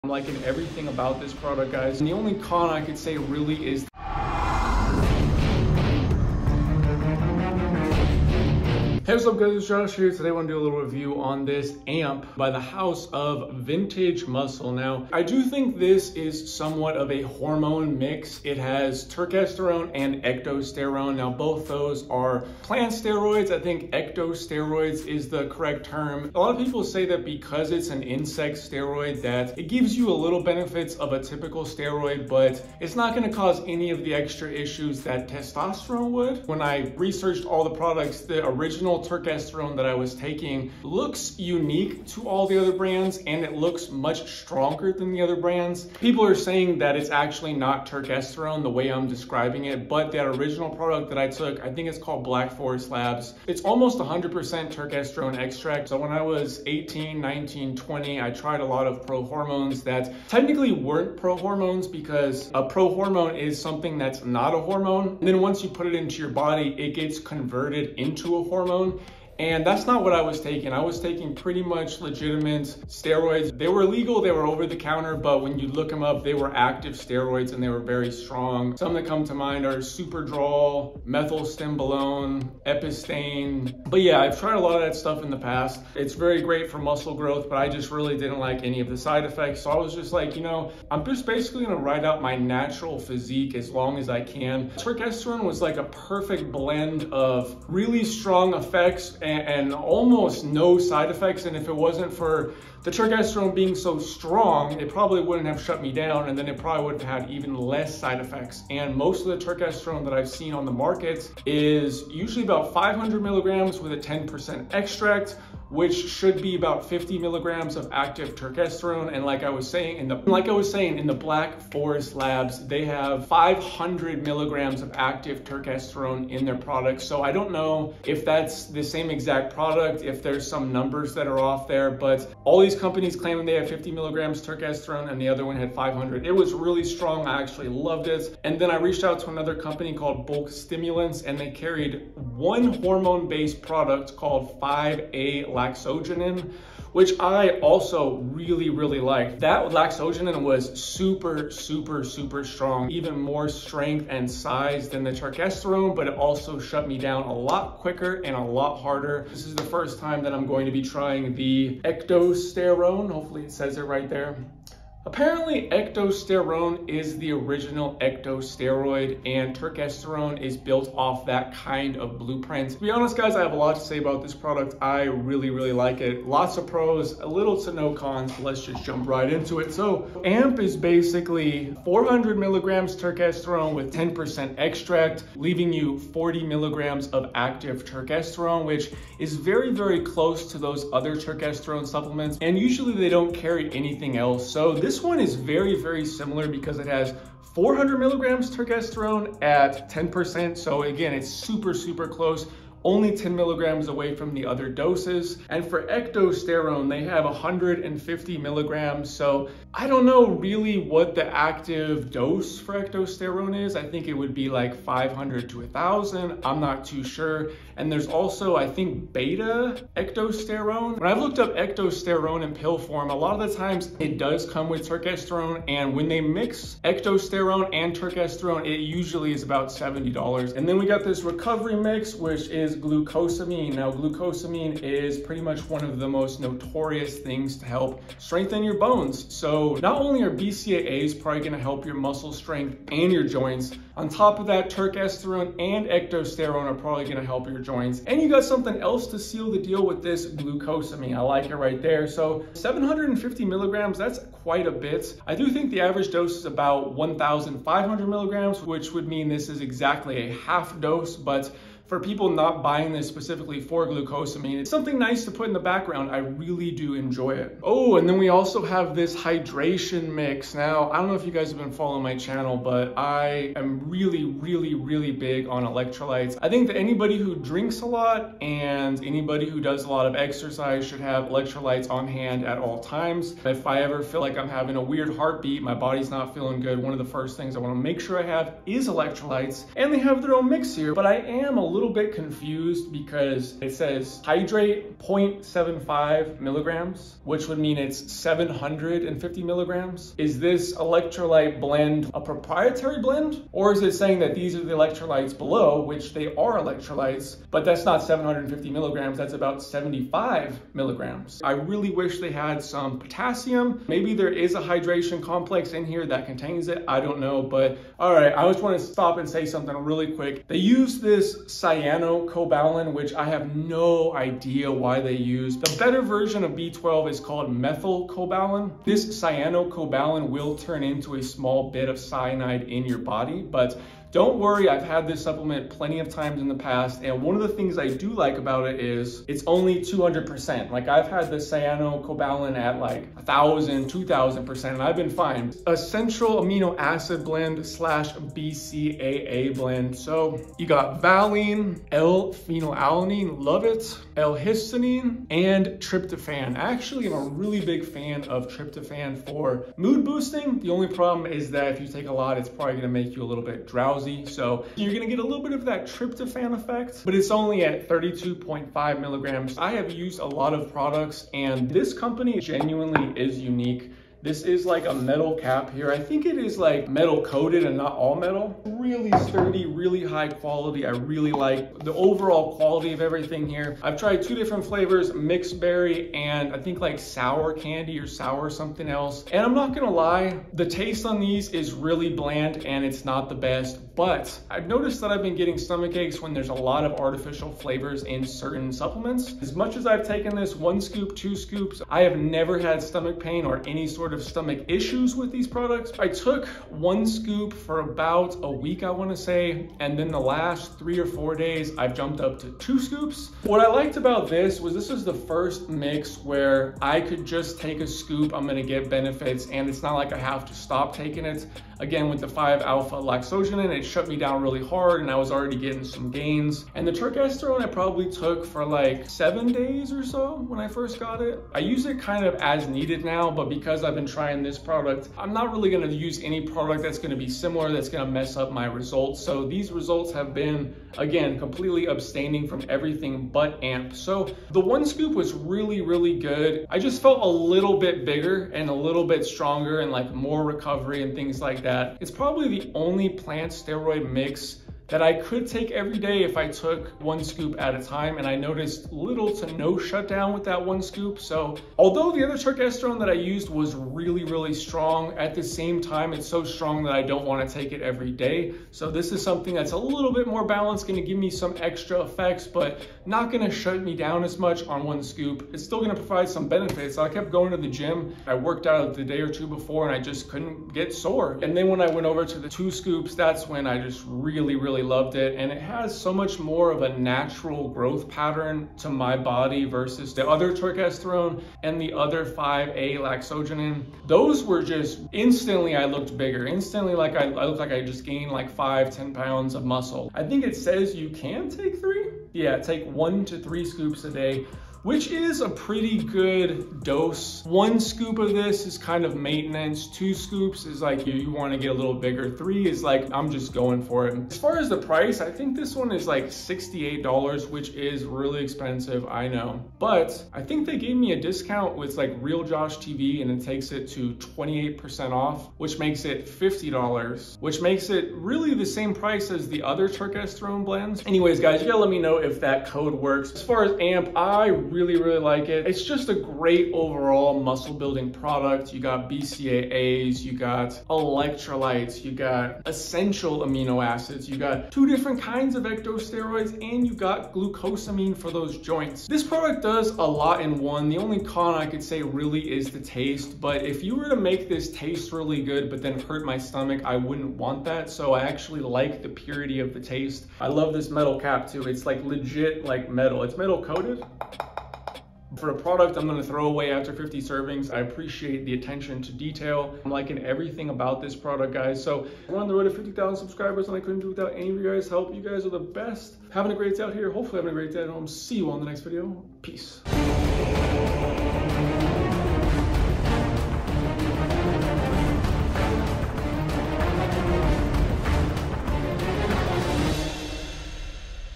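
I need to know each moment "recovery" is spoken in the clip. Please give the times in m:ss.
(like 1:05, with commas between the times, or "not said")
3:51, 7:30.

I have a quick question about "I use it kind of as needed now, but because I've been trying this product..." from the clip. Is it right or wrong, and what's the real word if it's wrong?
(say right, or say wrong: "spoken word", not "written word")
right.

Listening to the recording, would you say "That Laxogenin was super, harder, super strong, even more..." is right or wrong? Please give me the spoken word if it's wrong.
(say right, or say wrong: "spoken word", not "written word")
wrong: "super", not "harder".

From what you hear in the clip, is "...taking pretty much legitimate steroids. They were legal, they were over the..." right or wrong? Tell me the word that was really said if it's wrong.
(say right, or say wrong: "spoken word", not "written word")
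right.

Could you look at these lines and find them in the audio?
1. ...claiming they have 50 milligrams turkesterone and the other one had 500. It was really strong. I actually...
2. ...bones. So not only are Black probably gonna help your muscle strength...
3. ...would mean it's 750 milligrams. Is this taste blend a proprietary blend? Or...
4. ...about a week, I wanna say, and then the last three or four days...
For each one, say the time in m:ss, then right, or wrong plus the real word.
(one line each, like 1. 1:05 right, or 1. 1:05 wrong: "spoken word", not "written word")
1. 2:13 right
2. 3:58 wrong: "BCAAs", not "Black"
3. 4:57 wrong: "electrolyte", not "taste"
4. 6:47 right.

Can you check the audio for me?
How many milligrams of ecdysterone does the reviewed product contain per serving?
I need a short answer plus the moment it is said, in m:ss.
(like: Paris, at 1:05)
150 milligrams, at 3:27.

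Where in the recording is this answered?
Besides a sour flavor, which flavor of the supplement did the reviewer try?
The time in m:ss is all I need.
6:25.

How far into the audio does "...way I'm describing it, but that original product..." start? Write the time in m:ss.
0:48.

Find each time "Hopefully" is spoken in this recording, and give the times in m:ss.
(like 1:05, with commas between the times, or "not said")
2:43, 9:37.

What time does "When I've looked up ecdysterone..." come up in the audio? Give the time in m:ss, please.
3:40.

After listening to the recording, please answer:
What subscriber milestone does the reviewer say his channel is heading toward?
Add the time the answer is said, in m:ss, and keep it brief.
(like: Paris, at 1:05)
50,000, at 9:32.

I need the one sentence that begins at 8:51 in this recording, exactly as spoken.
Anyways, guys, you gotta let me know if that code works.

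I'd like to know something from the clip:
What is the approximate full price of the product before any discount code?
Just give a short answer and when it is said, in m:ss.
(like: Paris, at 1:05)
$68, at 8:36.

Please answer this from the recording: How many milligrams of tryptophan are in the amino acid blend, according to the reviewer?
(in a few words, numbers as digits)
32.5 milligrams.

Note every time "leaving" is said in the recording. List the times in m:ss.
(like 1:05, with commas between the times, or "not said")
3:05.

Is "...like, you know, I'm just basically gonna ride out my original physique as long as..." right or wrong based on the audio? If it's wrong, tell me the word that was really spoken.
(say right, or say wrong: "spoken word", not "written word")
wrong: "natural", not "original".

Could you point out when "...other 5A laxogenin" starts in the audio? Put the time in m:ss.
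8:11.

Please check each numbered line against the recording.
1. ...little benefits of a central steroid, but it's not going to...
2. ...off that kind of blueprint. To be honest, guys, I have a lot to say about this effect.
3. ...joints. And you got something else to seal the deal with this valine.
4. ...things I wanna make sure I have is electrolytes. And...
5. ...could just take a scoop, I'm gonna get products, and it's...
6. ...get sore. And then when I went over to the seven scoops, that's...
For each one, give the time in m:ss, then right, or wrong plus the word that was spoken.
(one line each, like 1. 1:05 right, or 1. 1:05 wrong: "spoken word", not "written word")
1. 0:30 wrong: "typical", not "central"
2. 2:50 wrong: "product", not "effect"
3. 4:07 wrong: "glucosamine", not "valine"
4. 4:47 right
5. 6:57 wrong: "benefits", not "products"
6. 8:00 wrong: "two", not "seven".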